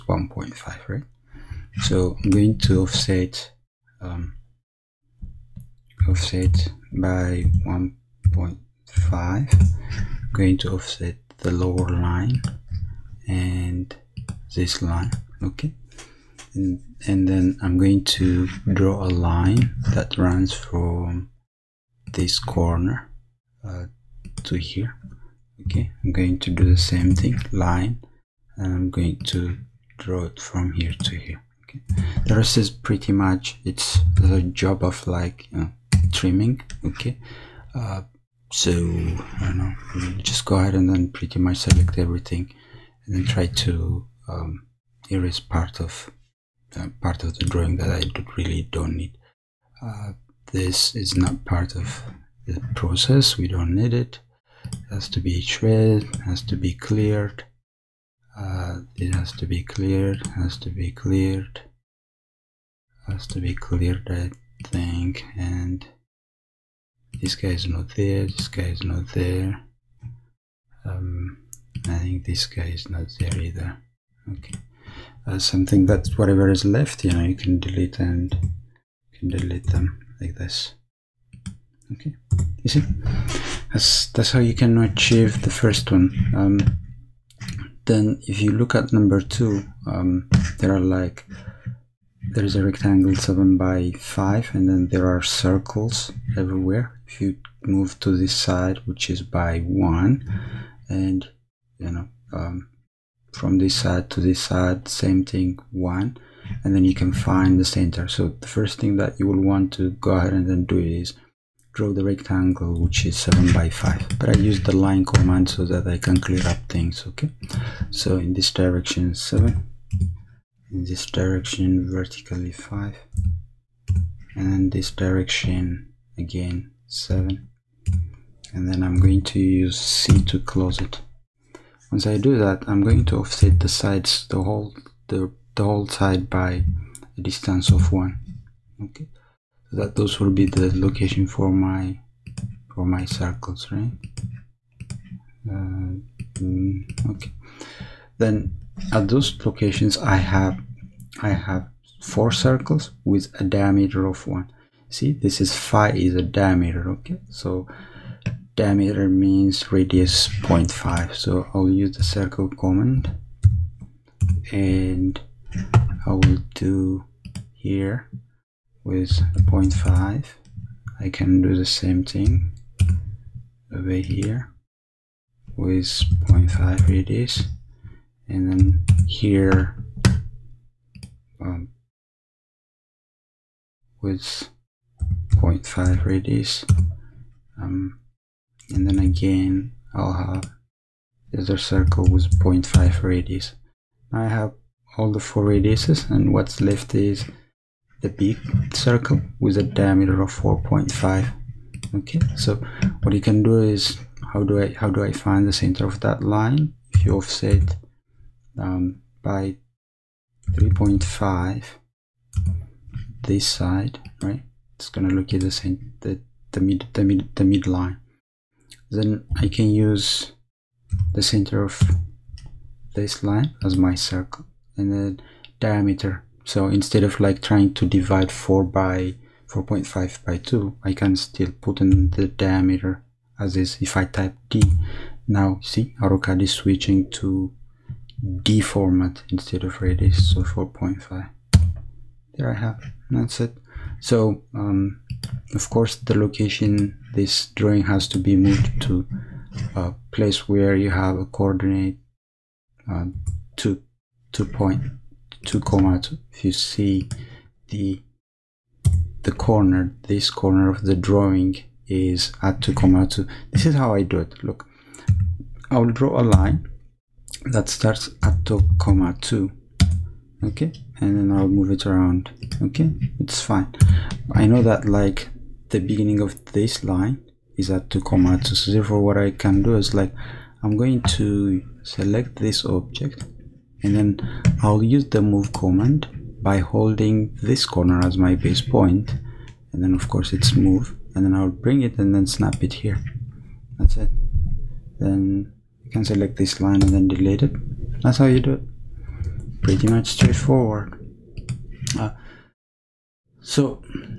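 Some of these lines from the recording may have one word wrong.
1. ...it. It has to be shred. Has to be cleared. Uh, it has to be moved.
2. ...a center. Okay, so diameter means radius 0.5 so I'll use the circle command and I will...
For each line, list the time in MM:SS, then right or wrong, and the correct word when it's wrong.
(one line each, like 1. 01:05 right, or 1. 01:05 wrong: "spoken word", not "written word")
1. 00:53 wrong: "cleared", not "moved"
2. 02:36 wrong: "diameter", not "center".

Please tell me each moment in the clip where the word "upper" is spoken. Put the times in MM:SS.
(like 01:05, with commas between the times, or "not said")
not said.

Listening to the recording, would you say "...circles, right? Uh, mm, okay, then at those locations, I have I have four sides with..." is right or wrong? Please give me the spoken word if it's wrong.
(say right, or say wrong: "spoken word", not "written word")
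wrong: "circles", not "sides".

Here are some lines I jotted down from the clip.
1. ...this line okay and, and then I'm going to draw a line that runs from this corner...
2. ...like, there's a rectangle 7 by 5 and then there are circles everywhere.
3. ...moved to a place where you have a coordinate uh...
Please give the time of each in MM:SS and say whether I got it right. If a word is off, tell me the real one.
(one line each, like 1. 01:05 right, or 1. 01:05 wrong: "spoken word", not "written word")
1. 00:14 right
2. 01:30 right
3. 04:08 right.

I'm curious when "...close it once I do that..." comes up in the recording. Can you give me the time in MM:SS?
02:10.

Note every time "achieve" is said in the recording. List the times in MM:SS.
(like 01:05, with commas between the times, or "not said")
01:24.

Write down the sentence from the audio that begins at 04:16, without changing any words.
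If you see the the corner, this corner of the drawing is at two comma two.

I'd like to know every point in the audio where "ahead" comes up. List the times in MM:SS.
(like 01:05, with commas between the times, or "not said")
00:40, 01:50.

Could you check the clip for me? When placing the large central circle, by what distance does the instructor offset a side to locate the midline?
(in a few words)
3.5.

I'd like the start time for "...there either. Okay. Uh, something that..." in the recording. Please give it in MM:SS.
01:13.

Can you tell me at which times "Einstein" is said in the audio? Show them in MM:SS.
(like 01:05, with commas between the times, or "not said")
not said.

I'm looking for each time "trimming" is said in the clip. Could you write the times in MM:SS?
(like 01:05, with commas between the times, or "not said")
00:36.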